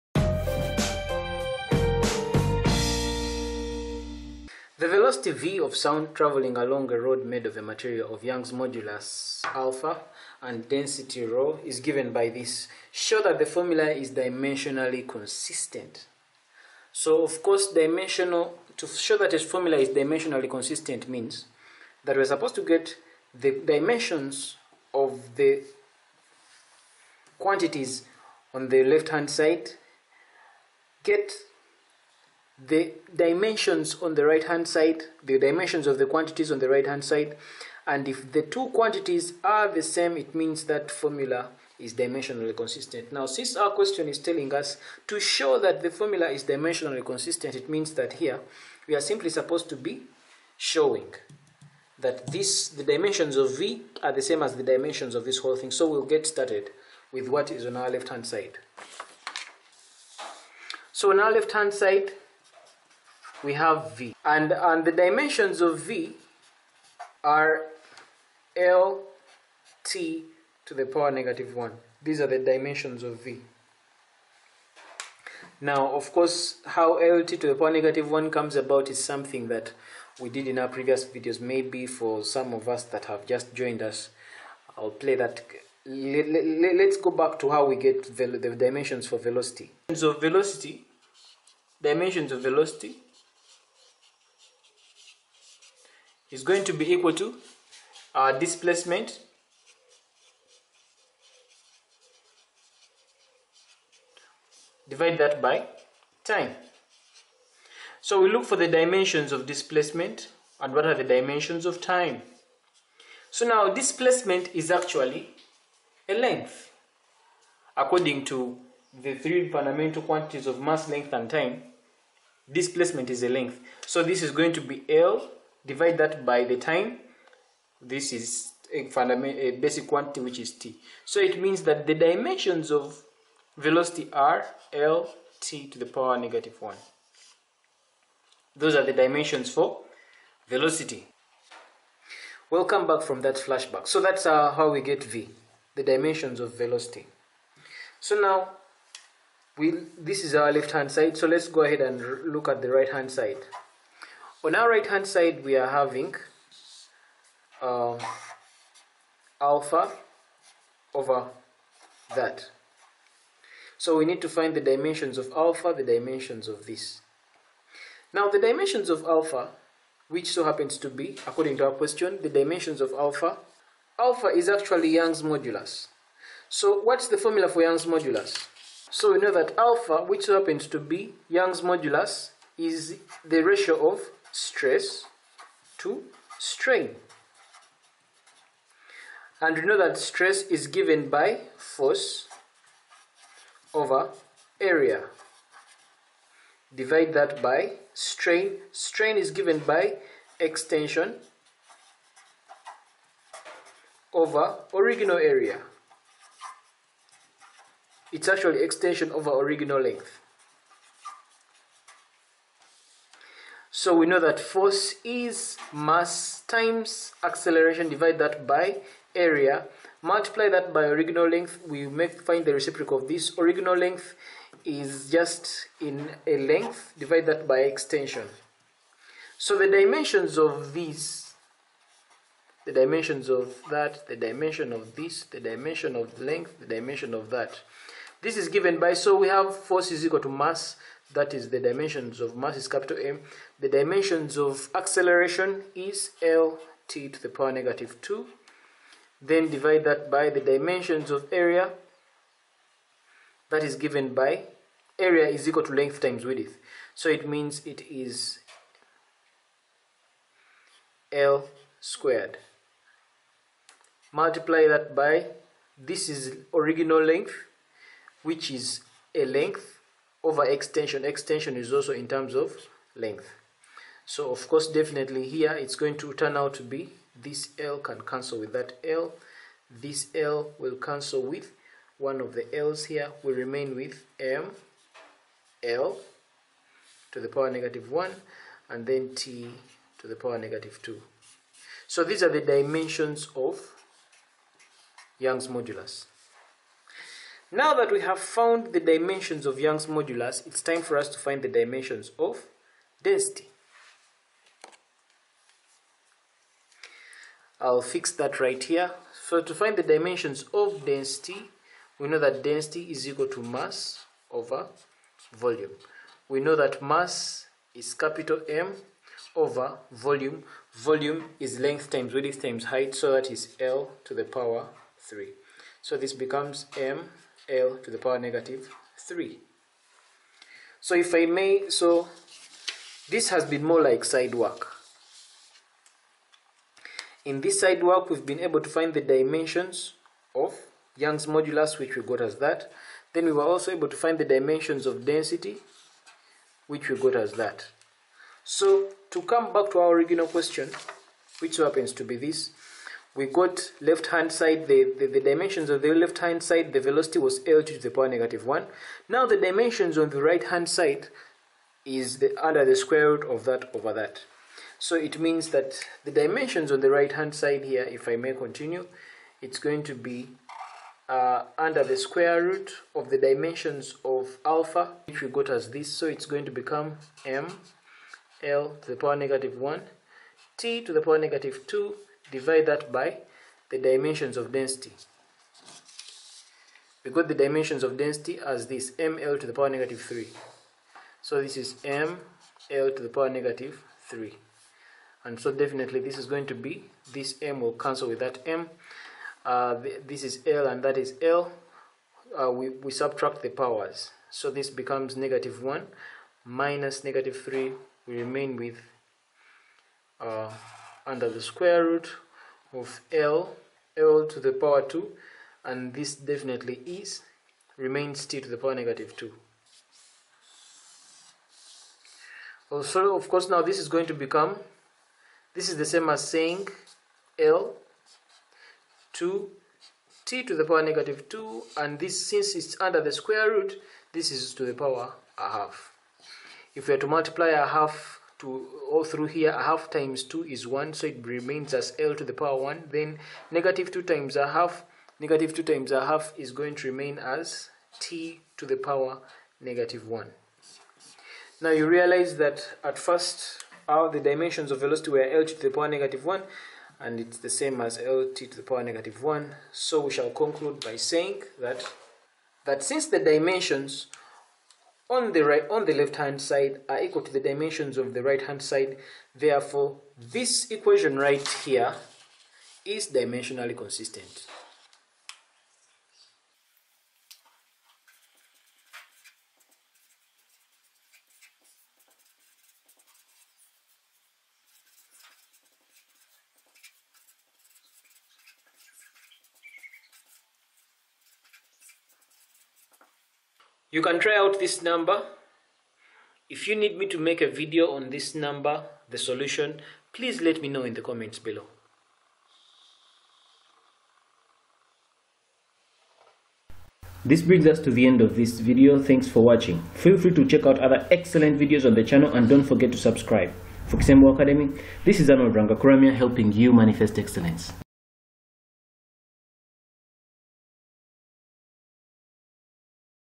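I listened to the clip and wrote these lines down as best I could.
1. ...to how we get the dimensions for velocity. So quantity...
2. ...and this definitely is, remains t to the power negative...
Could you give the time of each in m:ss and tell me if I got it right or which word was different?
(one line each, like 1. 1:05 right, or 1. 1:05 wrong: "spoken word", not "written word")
1. 1:27 wrong: "velocity", not "quantity"
2. 6:55 right.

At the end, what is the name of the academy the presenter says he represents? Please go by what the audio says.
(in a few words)
Kisembo Academy.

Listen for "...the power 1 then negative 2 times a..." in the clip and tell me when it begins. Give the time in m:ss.
7:22.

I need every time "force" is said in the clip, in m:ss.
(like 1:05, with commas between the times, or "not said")
3:11, 3:34, 3:59.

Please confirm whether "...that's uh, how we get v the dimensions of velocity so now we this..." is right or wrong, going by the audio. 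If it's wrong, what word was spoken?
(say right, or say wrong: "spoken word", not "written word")
right.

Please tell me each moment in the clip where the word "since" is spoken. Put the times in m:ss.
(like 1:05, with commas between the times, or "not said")
0:43, 7:12, 7:42.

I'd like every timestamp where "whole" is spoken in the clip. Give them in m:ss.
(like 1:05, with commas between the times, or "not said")
0:55.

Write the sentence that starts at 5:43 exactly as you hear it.
Then we were also able to find the dimensions of density, which we got as that.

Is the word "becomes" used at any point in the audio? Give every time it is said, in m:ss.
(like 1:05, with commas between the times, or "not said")
5:26, 6:16, 6:44, 7:04.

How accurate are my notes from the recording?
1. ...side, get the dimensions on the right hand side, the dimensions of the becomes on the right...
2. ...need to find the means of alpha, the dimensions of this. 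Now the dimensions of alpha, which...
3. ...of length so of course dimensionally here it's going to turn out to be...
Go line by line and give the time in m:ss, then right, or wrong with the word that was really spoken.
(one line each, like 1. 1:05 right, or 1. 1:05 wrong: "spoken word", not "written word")
1. 0:29 wrong: "quantities", not "becomes"
2. 2:44 wrong: "dimensions", not "means"
3. 4:32 wrong: "definitely", not "dimensionally".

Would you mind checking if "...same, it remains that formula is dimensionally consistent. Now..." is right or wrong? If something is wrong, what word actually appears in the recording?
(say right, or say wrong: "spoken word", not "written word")
wrong: "means", not "remains".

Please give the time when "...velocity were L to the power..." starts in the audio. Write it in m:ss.
7:34.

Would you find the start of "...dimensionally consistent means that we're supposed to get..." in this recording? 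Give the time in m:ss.
0:19.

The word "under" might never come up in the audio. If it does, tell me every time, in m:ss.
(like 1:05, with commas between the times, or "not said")
6:02, 6:11, 6:51, 7:12.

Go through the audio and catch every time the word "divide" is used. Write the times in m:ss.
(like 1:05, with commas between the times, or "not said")
1:44, 2:05, 3:16, 3:37, 3:46, 4:09, 6:22.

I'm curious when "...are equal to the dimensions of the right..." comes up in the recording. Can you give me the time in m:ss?
7:46.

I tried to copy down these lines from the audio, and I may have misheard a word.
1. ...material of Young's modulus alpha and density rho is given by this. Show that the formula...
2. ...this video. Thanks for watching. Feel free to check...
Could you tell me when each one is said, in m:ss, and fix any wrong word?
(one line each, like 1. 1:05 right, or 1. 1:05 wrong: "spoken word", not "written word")
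1. 0:07 right
2. 8:28 right.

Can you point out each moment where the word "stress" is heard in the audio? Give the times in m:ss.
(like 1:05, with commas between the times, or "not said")
3:04, 3:09.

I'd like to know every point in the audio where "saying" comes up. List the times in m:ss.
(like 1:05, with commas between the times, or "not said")
7:06, 7:40.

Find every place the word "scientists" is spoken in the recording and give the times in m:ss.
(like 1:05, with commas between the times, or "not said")
not said.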